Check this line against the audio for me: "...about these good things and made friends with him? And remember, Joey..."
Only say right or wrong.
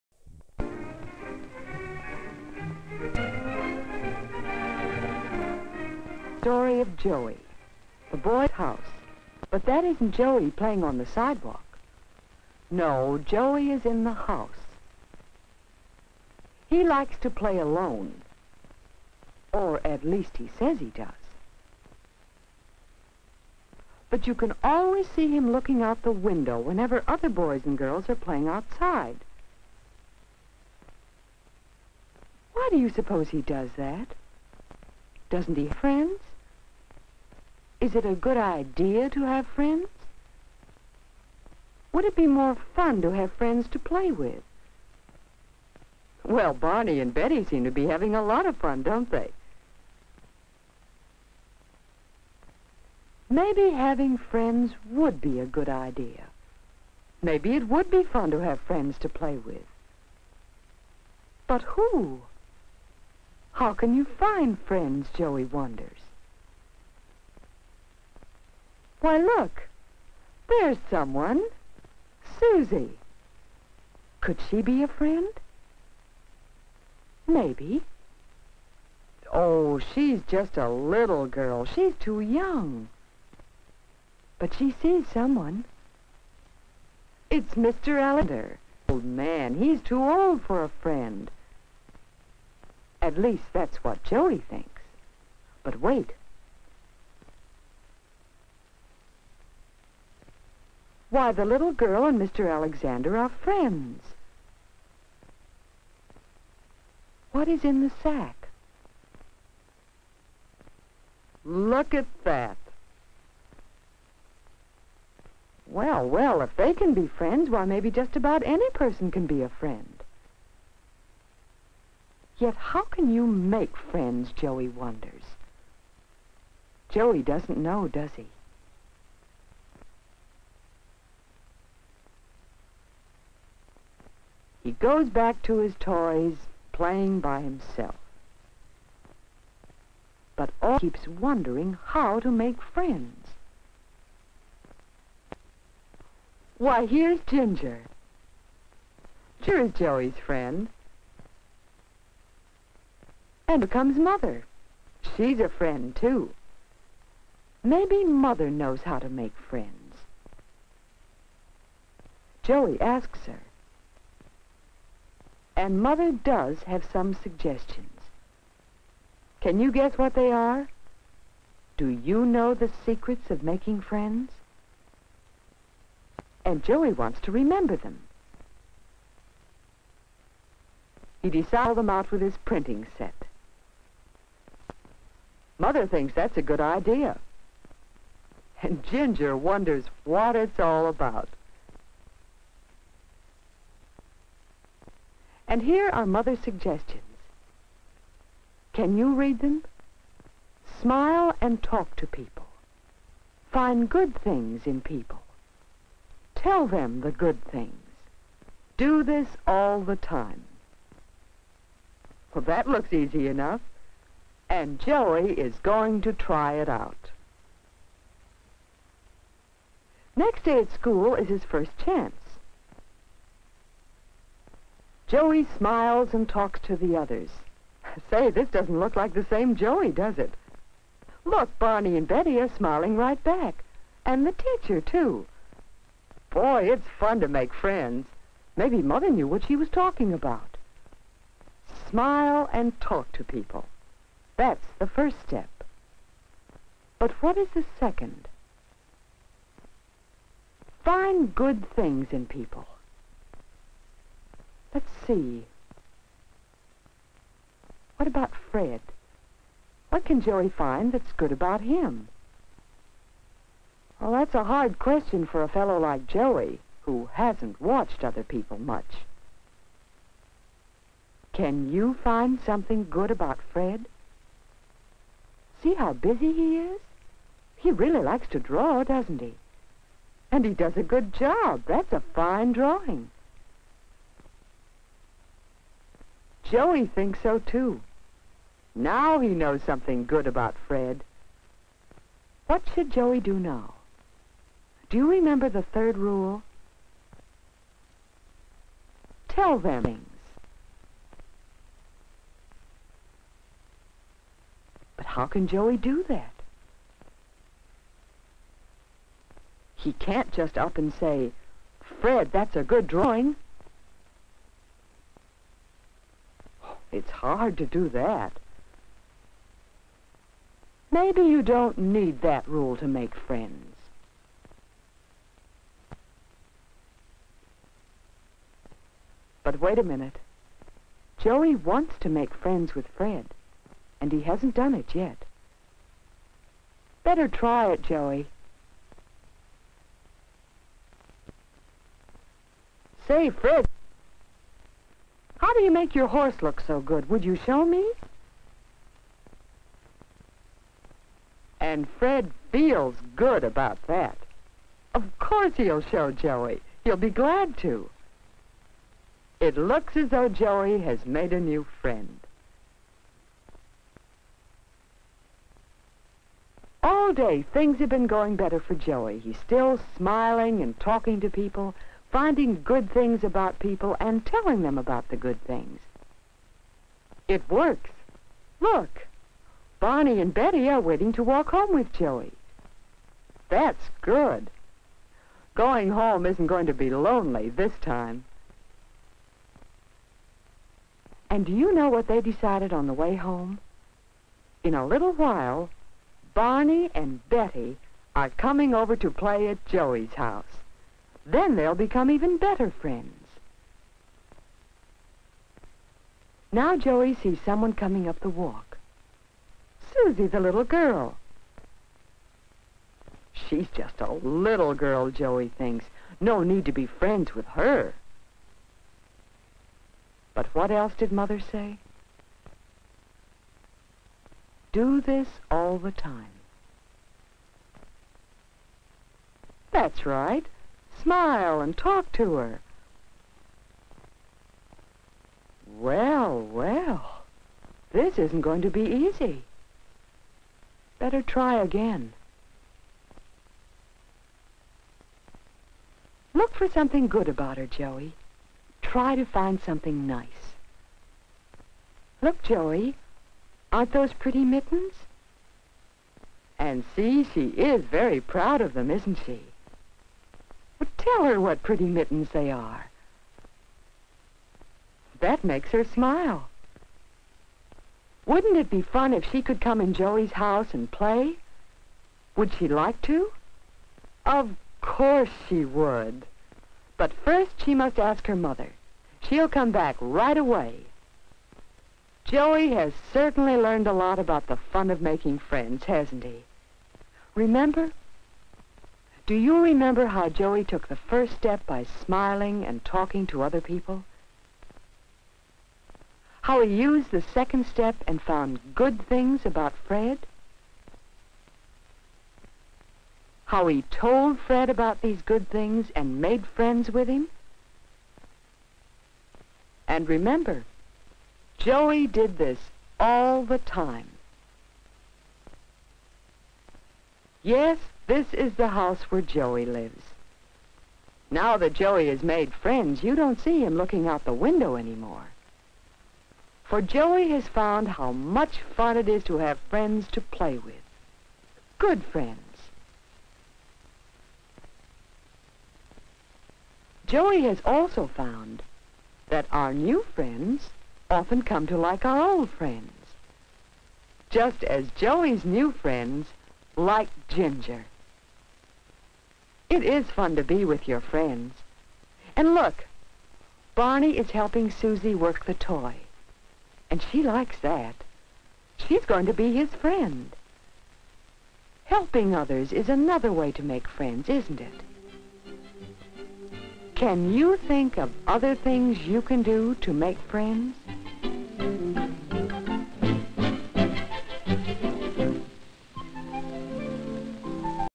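right.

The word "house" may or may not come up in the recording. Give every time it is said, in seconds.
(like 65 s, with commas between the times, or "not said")
8 s, 14 s, 400 s, 470 s, 518 s.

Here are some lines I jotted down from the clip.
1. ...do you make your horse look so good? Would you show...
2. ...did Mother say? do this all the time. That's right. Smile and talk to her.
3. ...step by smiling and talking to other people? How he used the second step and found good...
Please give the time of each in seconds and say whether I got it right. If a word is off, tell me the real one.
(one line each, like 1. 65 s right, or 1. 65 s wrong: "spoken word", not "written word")
1. 345 s right
2. 420 s right
3. 491 s right.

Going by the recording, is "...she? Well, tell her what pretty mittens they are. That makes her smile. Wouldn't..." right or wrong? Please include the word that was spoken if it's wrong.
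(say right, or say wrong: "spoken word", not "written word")
right.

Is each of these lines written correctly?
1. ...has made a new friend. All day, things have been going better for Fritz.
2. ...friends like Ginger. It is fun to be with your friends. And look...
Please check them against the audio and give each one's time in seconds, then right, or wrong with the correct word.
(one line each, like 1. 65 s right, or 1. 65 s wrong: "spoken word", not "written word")
1. 360 s wrong: "Joey", not "Fritz"
2. 545 s right.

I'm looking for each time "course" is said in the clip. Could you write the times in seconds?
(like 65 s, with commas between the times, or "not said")
355 s, 474 s.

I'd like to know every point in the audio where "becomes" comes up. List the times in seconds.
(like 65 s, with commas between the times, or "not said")
153 s, 401 s.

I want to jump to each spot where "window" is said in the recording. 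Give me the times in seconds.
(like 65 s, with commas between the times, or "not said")
26 s, 524 s.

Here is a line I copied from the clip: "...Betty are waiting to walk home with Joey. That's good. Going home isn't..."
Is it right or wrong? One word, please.
right.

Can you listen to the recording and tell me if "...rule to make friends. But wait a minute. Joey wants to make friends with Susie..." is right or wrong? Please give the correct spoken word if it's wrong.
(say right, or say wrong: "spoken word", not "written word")
wrong: "Fred", not "Susie".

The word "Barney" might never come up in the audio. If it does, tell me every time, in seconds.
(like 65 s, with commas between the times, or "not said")
46 s, 231 s, 379 s, 396 s, 553 s.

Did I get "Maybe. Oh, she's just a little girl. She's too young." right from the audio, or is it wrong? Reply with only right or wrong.
right.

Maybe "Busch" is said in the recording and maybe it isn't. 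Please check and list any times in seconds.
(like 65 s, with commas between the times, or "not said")
not said.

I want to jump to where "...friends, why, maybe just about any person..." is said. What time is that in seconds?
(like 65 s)
117 s.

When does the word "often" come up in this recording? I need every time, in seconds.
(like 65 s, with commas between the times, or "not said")
541 s.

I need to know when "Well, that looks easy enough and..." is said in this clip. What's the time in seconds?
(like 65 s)
212 s.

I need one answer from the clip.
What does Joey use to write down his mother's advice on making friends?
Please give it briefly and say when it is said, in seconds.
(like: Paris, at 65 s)
His printing set, at 182 s.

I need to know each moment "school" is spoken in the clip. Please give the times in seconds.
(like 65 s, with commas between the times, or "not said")
220 s.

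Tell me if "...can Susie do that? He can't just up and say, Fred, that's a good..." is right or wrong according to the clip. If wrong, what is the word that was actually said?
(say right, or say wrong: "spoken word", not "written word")
wrong: "Joey", not "Susie".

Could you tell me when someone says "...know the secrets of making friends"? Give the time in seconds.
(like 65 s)
172 s.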